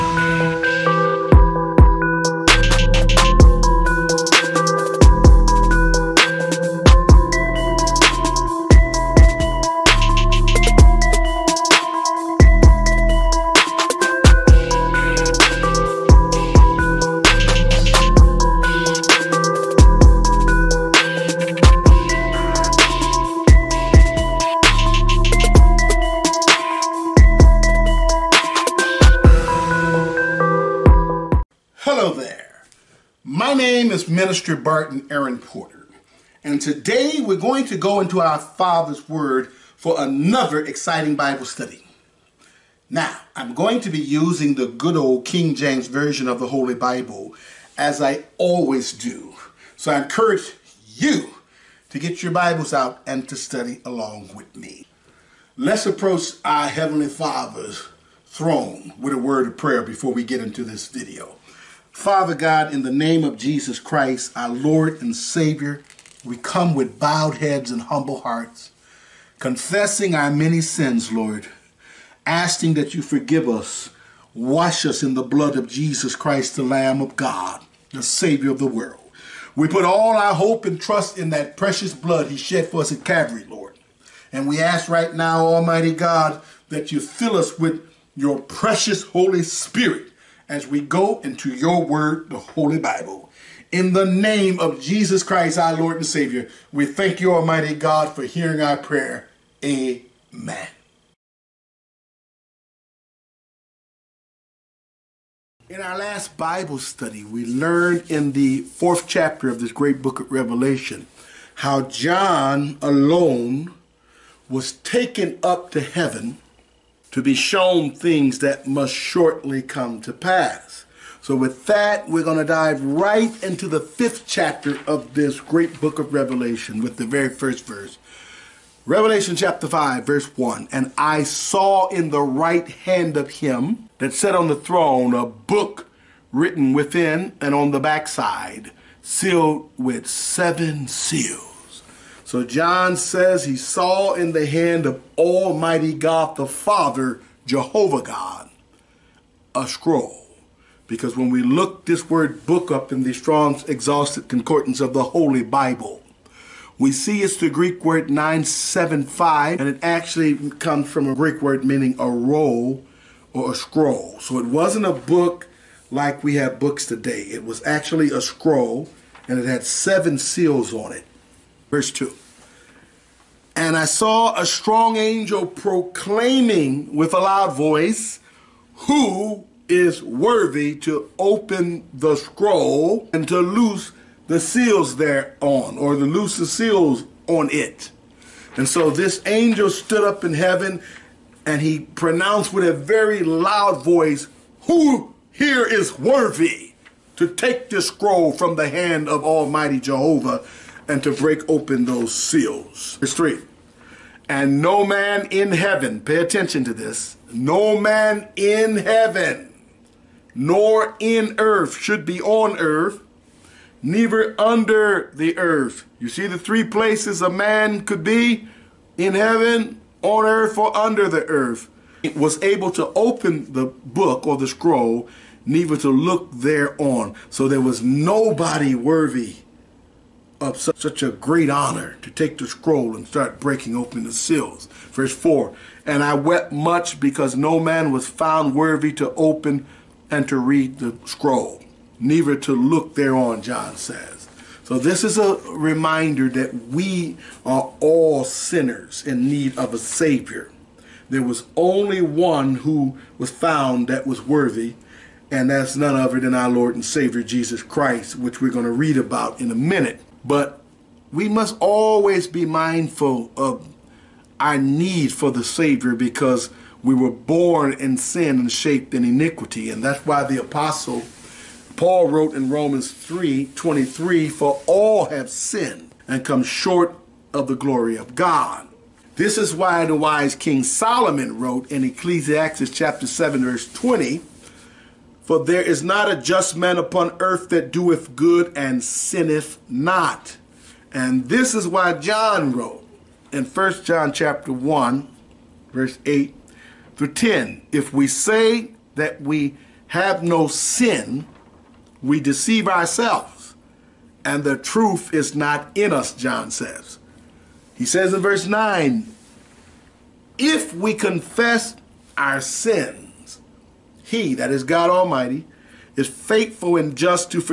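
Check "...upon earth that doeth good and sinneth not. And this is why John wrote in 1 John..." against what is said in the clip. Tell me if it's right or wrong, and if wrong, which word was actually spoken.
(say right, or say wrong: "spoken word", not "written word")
right.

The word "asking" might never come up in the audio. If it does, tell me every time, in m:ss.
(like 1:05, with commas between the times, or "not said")
1:12.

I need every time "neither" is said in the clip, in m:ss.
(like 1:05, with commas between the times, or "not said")
3:33, 3:45, 4:01.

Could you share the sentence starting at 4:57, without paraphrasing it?
If we say that we have no sin, we deceive ourselves, and the truth is not in us, John says.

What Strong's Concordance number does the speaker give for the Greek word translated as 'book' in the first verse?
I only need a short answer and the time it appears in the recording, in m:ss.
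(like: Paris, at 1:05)
975, at 2:38.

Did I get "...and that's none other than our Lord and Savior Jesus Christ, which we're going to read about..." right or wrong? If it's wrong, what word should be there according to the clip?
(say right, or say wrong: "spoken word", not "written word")
right.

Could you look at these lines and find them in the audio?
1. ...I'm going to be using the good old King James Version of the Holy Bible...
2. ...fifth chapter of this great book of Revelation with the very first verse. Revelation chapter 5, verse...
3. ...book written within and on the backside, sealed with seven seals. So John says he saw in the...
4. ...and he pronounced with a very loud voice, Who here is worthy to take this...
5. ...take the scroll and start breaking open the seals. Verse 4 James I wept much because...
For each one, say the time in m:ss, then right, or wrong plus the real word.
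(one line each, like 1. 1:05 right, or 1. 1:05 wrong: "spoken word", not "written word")
1. 0:43 right
2. 2:03 right
3. 2:15 right
4. 3:11 right
5. 3:52 wrong: "And", not "James".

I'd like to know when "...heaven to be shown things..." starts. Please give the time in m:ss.
1:55.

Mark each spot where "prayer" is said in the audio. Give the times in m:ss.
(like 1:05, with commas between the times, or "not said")
0:59, 1:38.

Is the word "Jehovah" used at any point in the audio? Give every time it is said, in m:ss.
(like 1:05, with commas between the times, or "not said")
2:27, 3:19.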